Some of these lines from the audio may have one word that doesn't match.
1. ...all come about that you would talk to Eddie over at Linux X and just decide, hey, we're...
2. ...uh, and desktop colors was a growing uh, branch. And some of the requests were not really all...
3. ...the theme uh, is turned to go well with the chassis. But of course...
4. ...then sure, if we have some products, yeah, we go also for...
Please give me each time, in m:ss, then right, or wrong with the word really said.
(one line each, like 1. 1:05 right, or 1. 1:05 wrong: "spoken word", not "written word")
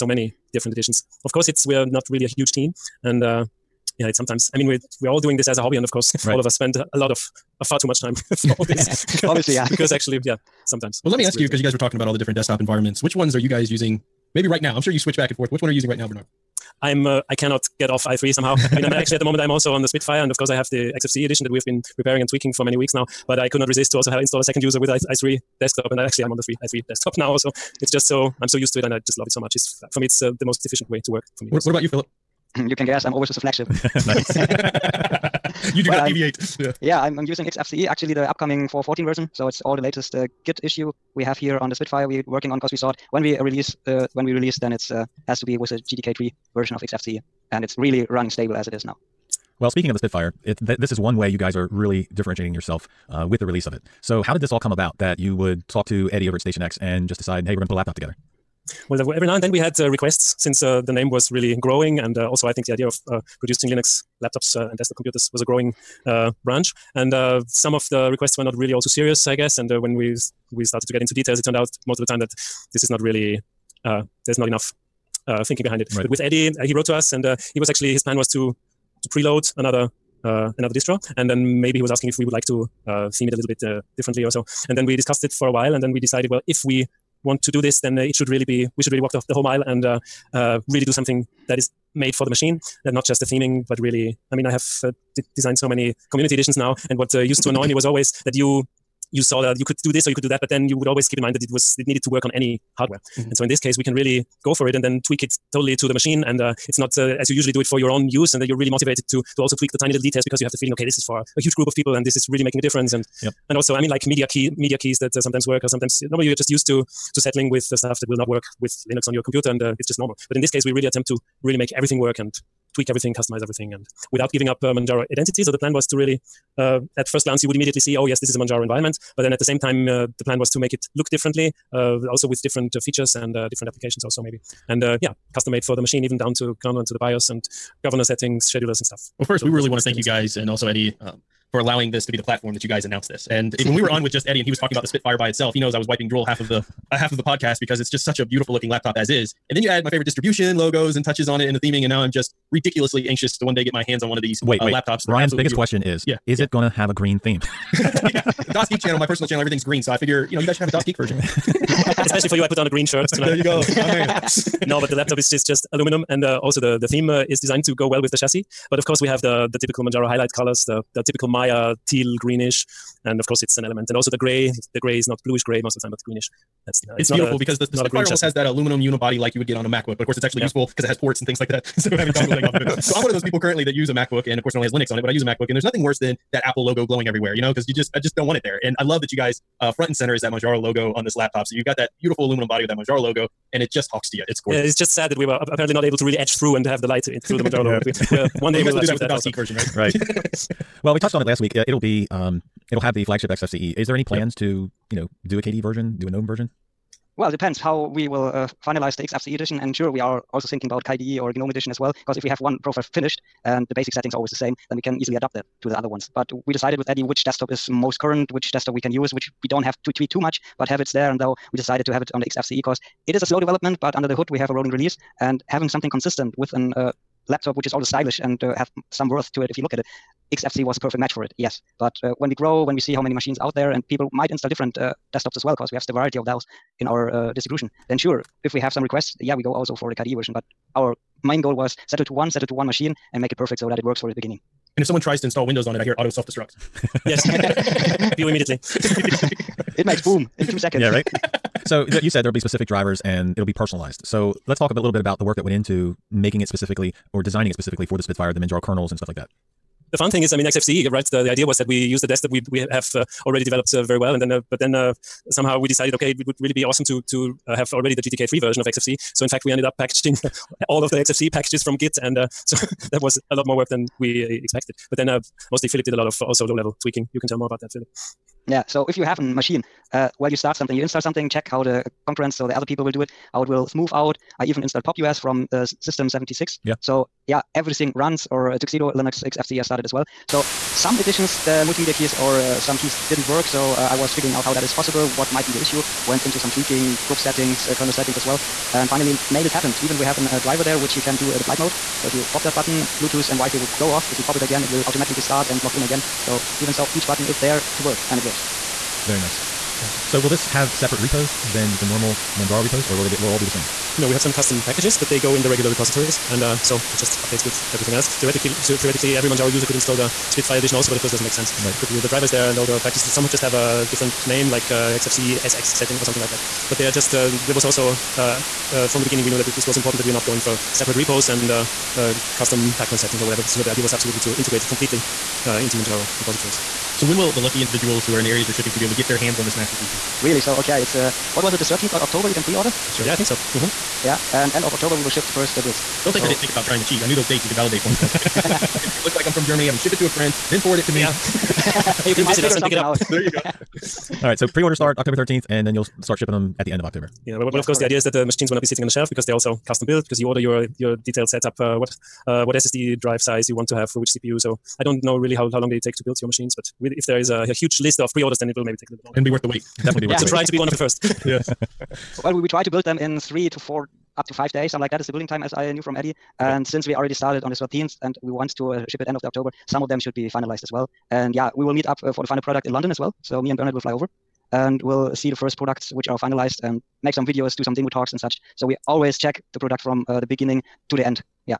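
1. 0:54 wrong: "Station", not "Linux"
2. 1:04 wrong: "computers", not "colors"
3. 2:46 wrong: "designed", not "turned"
4. 3:57 wrong: "requests", not "products".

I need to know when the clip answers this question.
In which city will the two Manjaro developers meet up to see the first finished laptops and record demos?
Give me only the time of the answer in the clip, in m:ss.
6:22.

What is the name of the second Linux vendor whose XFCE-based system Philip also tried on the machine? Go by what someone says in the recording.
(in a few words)
Tuxedo.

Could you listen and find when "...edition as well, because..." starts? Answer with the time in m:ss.
3:31.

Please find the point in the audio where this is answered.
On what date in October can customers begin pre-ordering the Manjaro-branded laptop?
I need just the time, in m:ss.
5:41.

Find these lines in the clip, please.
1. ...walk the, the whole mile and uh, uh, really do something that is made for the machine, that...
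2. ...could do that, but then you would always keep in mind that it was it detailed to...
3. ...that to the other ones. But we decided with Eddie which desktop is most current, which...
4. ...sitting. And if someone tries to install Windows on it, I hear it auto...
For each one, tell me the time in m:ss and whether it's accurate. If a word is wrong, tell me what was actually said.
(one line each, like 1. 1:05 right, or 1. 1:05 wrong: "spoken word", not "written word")
1. 1:29 right
2. 1:40 wrong: "needed", not "detailed"
3. 3:35 right
4. 4:04 wrong: "beginning", not "sitting".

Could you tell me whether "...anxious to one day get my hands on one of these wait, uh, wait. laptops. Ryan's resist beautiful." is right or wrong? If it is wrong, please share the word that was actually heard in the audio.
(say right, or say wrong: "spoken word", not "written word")
wrong: "biggest", not "resist".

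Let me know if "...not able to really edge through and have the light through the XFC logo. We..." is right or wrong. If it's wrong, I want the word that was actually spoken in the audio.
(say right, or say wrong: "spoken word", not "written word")
wrong: "Manjaro", not "XFC".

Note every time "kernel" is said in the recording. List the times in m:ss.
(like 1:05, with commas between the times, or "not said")
2:16, 4:18, 4:57.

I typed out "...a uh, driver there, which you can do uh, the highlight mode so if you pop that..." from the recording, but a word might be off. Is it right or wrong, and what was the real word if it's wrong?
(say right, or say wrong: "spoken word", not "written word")
wrong: "flight", not "highlight".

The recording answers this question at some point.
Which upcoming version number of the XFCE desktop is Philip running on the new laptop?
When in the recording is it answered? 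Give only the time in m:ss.
0:38.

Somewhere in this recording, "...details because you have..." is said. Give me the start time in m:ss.
1:50.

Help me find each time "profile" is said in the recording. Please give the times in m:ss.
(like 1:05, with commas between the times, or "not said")
3:32.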